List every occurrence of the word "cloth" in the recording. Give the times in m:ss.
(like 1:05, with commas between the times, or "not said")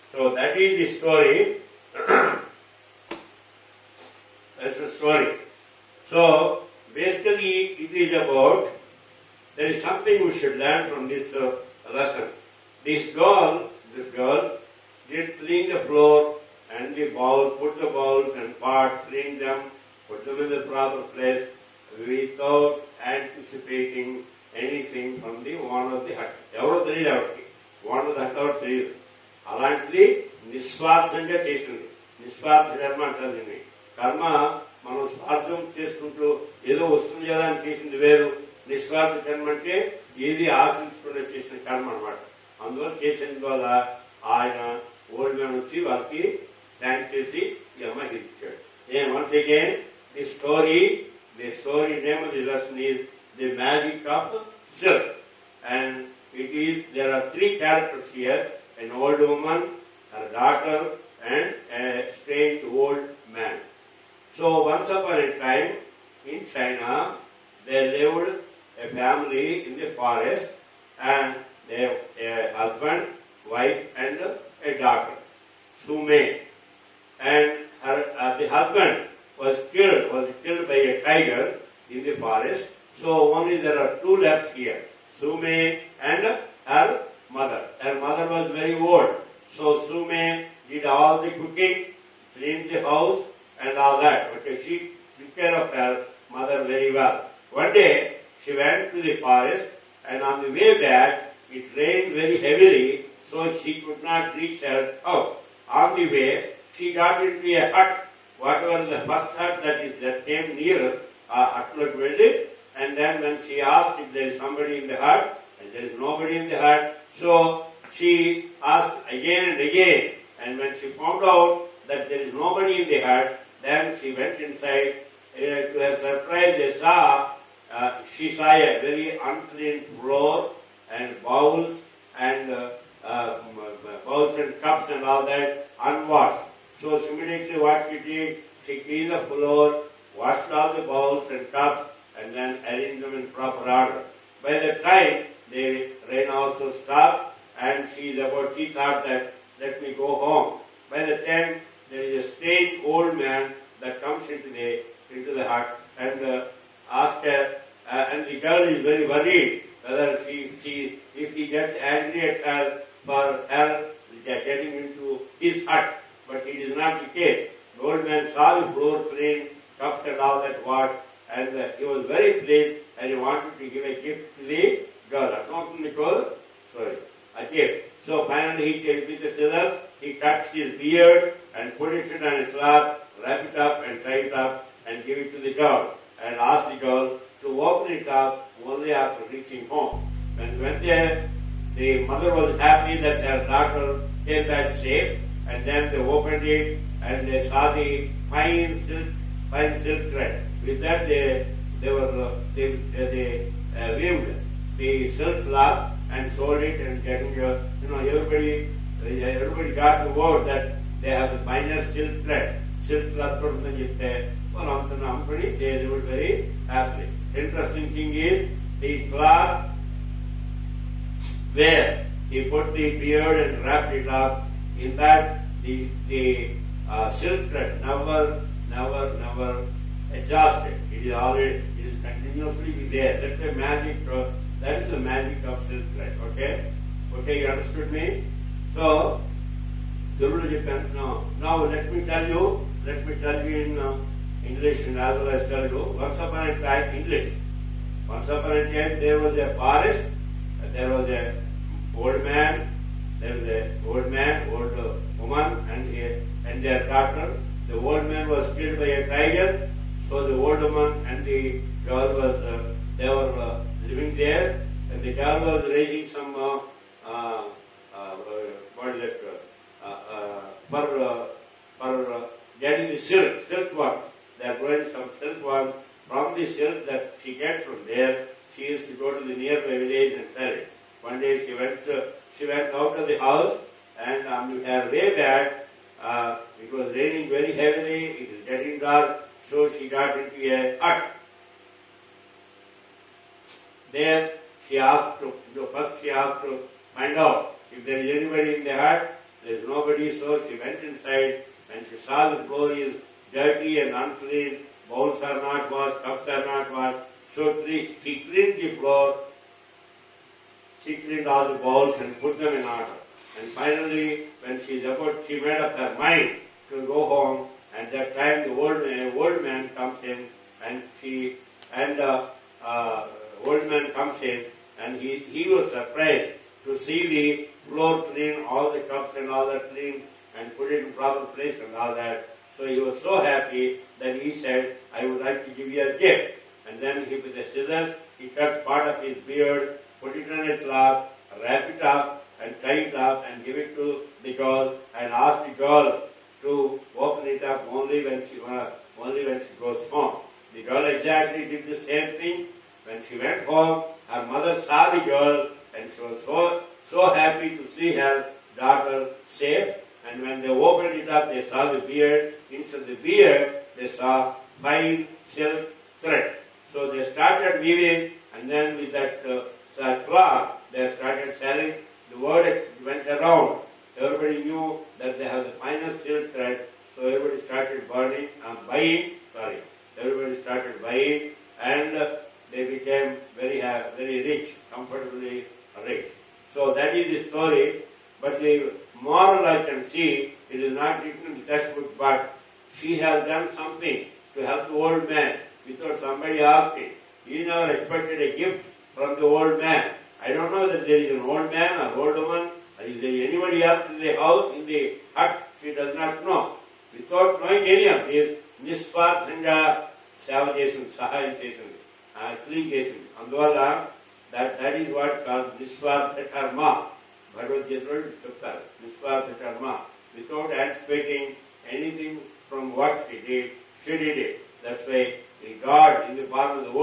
3:25, 3:33, 3:39, 5:40, 6:10.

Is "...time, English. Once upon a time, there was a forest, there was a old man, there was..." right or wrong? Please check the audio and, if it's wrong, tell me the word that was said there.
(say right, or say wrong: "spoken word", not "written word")
right.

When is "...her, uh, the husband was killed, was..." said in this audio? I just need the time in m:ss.
1:17.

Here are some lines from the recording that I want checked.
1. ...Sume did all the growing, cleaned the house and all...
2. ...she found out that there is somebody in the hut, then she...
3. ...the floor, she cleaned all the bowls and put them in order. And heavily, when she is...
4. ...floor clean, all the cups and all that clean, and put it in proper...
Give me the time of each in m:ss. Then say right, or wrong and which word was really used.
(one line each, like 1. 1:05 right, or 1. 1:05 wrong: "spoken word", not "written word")
1. 1:29 wrong: "cooking", not "growing"
2. 2:00 wrong: "nobody", not "somebody"
3. 5:08 wrong: "finally", not "heavily"
4. 5:27 right.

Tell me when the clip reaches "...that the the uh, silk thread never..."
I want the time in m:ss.
3:44.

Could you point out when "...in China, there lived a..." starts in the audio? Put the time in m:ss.
1:06.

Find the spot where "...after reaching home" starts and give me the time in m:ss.
3:08.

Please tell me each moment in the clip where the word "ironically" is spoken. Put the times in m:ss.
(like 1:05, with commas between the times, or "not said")
not said.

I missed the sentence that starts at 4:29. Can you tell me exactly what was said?
Uh, uh, for uh, for uh, getting the silk silk work.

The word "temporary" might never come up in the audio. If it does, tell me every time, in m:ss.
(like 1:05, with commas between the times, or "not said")
not said.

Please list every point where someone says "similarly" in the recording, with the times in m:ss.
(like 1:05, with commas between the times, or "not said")
2:16.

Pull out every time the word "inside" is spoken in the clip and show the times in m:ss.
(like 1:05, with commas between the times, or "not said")
2:04, 5:00.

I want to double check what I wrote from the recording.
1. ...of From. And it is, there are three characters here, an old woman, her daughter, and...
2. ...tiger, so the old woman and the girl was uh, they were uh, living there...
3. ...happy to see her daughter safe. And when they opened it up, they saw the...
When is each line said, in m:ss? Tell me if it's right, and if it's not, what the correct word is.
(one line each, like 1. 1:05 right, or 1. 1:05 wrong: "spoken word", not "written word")
1. 0:54 wrong: "Silk", not "From"
2. 4:19 right
3. 5:57 right.